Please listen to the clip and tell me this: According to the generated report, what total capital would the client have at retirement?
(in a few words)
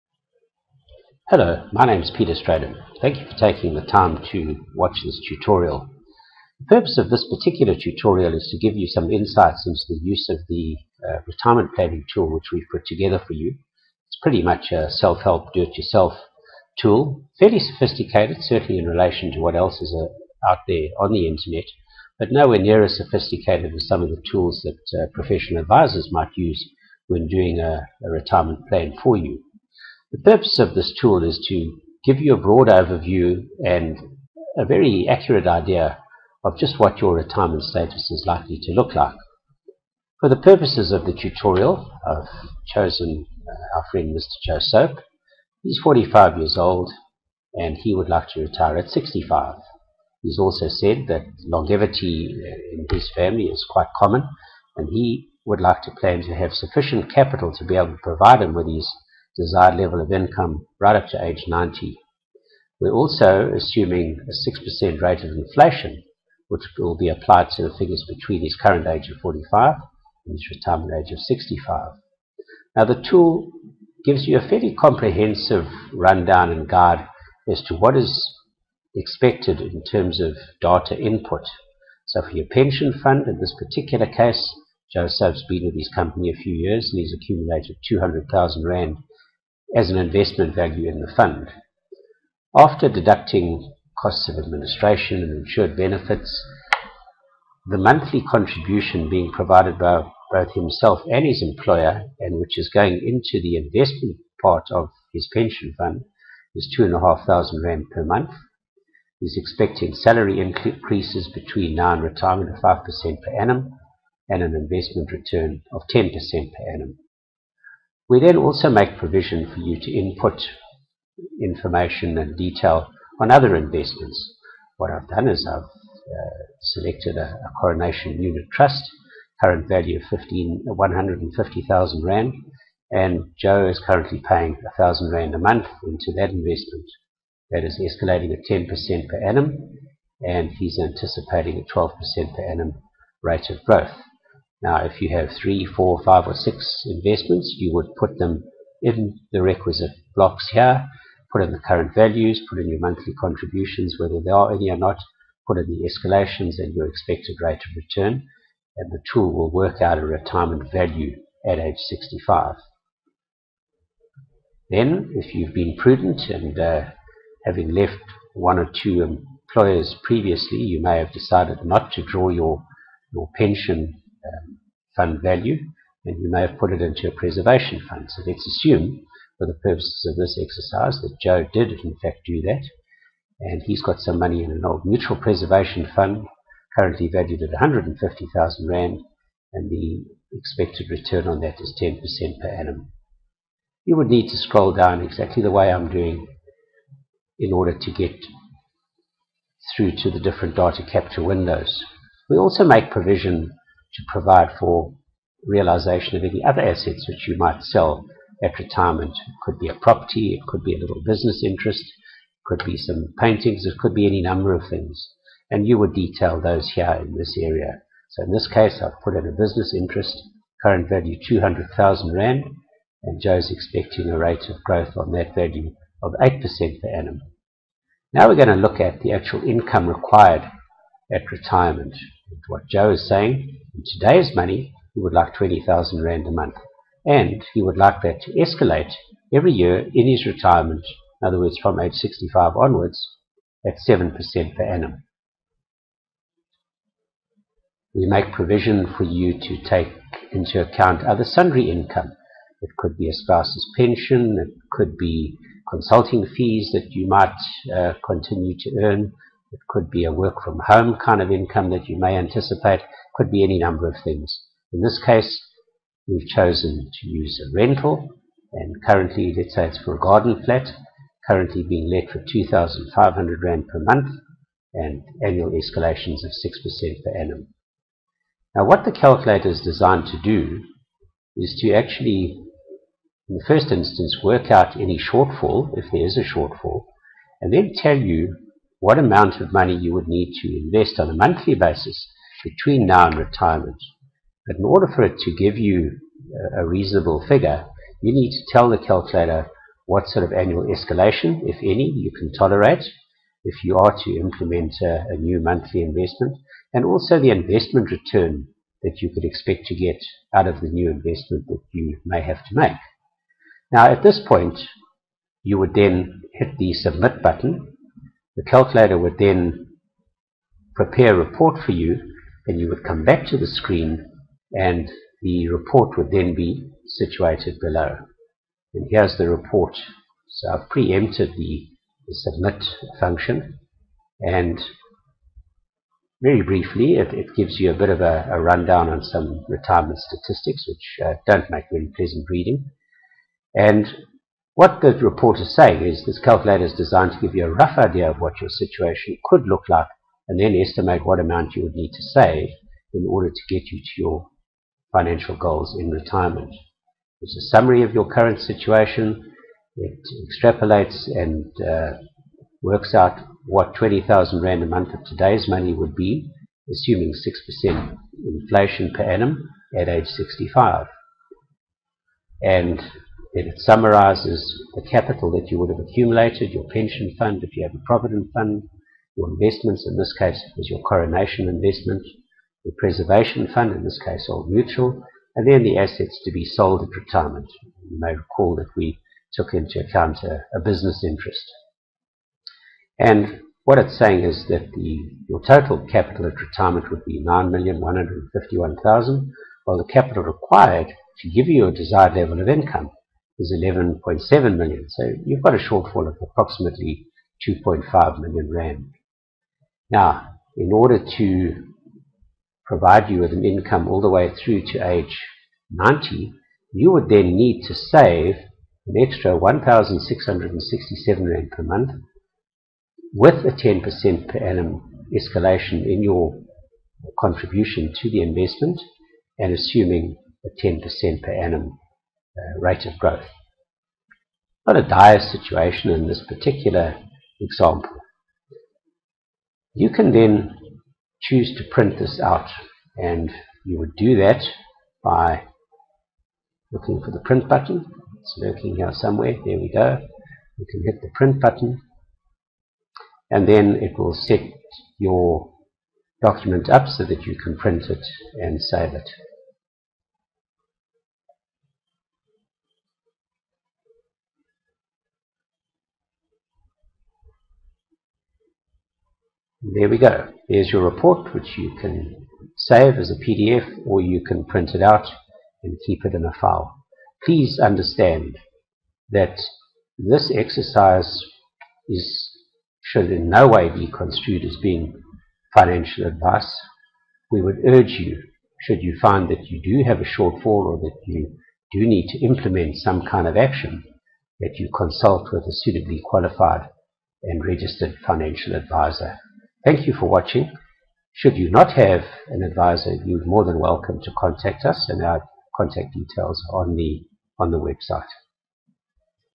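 9,151,000.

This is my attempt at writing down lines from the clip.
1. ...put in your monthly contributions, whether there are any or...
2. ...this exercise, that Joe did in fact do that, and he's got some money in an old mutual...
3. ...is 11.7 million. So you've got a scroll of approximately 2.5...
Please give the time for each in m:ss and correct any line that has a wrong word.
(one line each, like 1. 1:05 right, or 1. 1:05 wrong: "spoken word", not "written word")
1. 2:32 right
2. 3:00 right
3. 6:43 wrong: "shortfall", not "scroll".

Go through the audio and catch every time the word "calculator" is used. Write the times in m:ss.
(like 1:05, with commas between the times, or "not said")
4:38, 4:58, 5:18, 5:46.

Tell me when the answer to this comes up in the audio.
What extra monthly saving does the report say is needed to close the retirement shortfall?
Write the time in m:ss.
6:59.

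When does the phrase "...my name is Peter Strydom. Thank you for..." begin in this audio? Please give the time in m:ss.
0:01.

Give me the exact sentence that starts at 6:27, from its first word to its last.
You may recall that we took into account a, a business interest.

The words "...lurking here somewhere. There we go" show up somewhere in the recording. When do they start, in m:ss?
7:28.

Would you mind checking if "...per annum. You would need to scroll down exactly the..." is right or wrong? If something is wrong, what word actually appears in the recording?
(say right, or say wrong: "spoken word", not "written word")
right.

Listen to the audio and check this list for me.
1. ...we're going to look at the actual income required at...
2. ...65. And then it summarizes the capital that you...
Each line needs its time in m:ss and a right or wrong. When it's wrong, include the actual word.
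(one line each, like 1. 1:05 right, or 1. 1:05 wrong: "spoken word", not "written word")
1. 3:48 right
2. 6:10 right.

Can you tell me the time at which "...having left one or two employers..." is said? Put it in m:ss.
2:47.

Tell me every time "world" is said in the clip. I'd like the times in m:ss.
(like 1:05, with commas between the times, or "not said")
not said.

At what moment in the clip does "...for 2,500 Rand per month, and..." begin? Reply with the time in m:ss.
4:32.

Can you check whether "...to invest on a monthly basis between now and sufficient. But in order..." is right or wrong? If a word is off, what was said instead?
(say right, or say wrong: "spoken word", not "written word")
wrong: "retirement", not "sufficient".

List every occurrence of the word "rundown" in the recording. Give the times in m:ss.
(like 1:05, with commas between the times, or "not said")
1:15, 5:38.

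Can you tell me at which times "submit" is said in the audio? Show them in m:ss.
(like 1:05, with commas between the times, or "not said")
5:16, 5:32.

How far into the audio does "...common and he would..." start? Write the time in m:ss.
0:53.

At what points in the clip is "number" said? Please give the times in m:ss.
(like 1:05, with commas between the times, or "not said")
3:34, 4:23.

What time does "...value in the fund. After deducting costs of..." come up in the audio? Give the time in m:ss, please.
1:30.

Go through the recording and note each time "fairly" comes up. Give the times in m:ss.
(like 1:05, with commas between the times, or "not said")
0:17, 1:14.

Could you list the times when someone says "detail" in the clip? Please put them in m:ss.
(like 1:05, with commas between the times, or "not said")
2:02, 3:35, 8:25.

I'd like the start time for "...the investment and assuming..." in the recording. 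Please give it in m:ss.
7:08.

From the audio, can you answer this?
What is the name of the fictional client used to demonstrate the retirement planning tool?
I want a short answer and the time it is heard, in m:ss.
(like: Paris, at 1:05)
Joe Soap, at 0:44.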